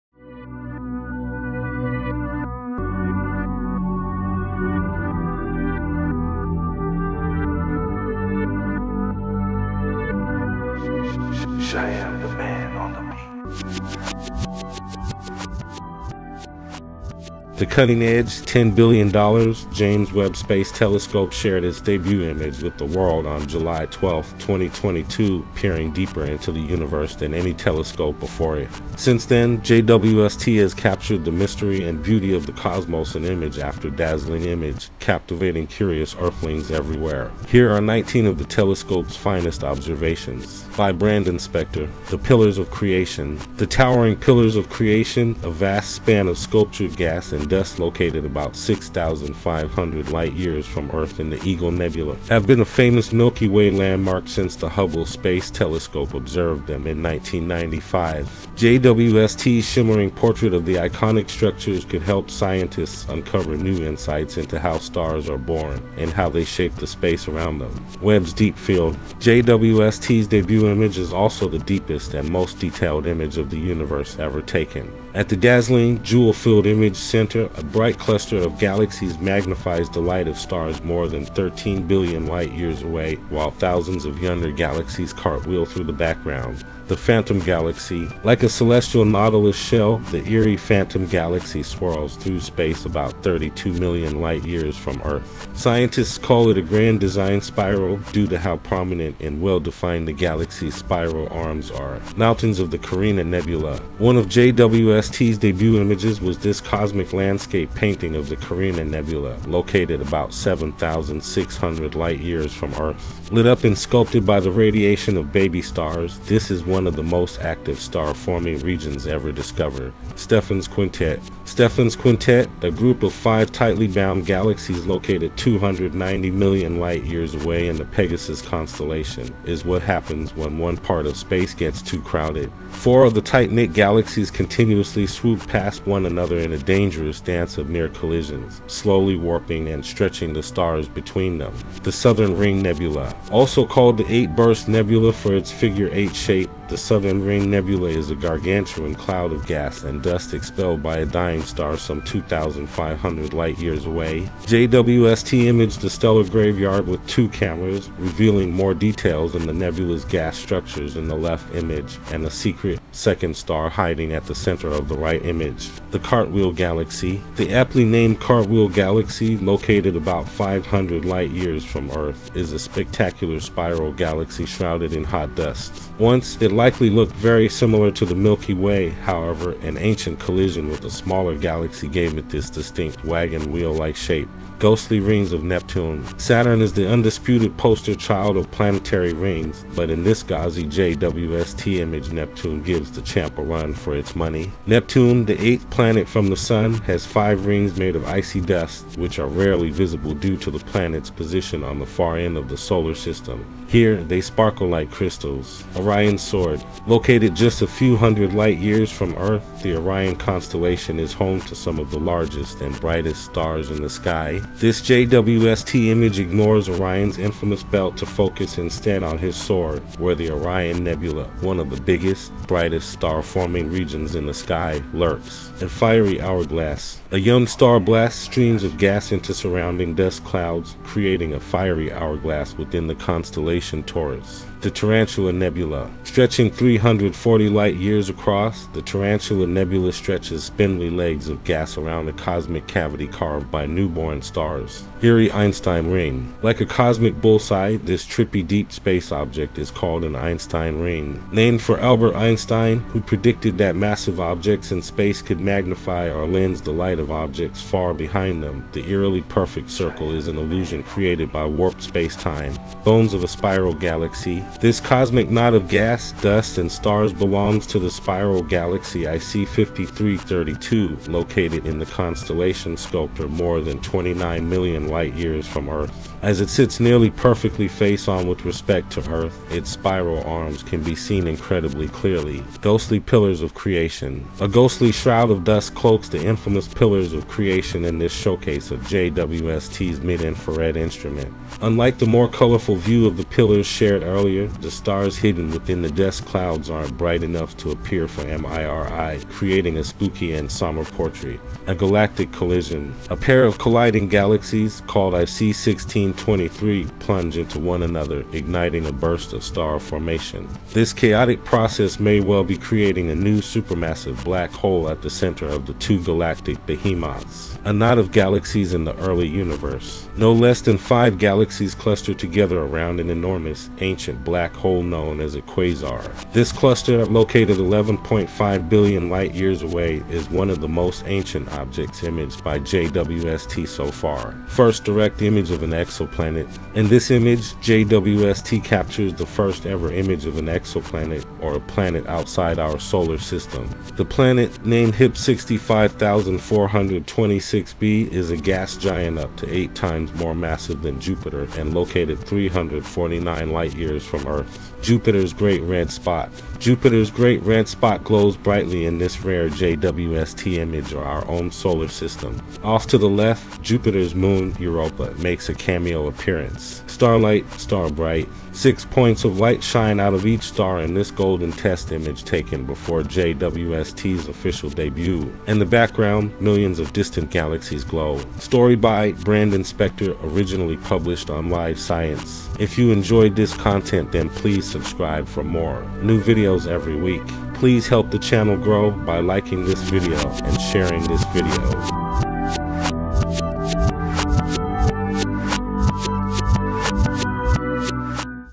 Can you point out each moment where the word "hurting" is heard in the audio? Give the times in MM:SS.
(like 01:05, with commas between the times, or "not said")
not said.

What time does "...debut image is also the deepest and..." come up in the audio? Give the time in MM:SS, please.
01:10.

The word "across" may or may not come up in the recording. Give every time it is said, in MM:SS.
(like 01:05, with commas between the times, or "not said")
03:58.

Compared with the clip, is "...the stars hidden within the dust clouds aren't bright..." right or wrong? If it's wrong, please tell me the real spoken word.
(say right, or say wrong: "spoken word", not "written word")
right.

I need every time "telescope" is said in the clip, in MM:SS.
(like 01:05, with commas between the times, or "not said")
00:20, 00:27, 00:38, 00:55.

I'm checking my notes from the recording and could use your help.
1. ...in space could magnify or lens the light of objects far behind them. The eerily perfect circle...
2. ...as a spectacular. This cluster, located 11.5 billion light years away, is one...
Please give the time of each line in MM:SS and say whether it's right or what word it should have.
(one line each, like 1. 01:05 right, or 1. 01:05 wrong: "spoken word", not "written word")
1. 04:14 right
2. 05:25 wrong: "quasar", not "spectacular".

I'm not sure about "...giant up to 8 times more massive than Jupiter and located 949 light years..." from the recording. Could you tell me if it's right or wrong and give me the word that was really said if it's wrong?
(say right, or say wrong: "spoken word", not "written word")
wrong: "349", not "949".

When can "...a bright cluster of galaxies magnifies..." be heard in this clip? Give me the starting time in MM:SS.
01:17.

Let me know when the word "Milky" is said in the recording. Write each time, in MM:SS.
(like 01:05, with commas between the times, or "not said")
00:53, 02:58.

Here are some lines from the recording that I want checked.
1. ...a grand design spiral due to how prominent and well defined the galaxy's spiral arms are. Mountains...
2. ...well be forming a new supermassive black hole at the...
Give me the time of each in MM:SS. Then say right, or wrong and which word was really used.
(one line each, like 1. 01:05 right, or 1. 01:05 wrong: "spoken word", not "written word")
1. 01:36 right
2. 05:12 wrong: "creating", not "forming".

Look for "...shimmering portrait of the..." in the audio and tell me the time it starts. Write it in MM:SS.
00:59.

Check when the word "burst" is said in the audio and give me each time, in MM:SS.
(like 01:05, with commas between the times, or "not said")
02:24, 05:08.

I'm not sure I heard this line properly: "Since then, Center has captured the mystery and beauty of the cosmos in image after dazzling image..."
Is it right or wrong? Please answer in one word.
wrong.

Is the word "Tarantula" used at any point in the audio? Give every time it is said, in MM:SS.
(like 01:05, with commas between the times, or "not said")
03:54, 03:58.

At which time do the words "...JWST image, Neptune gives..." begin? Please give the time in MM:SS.
03:10.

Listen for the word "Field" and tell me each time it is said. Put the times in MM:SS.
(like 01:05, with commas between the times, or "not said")
01:08, 01:16.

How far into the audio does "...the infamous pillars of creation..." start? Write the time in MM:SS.
04:46.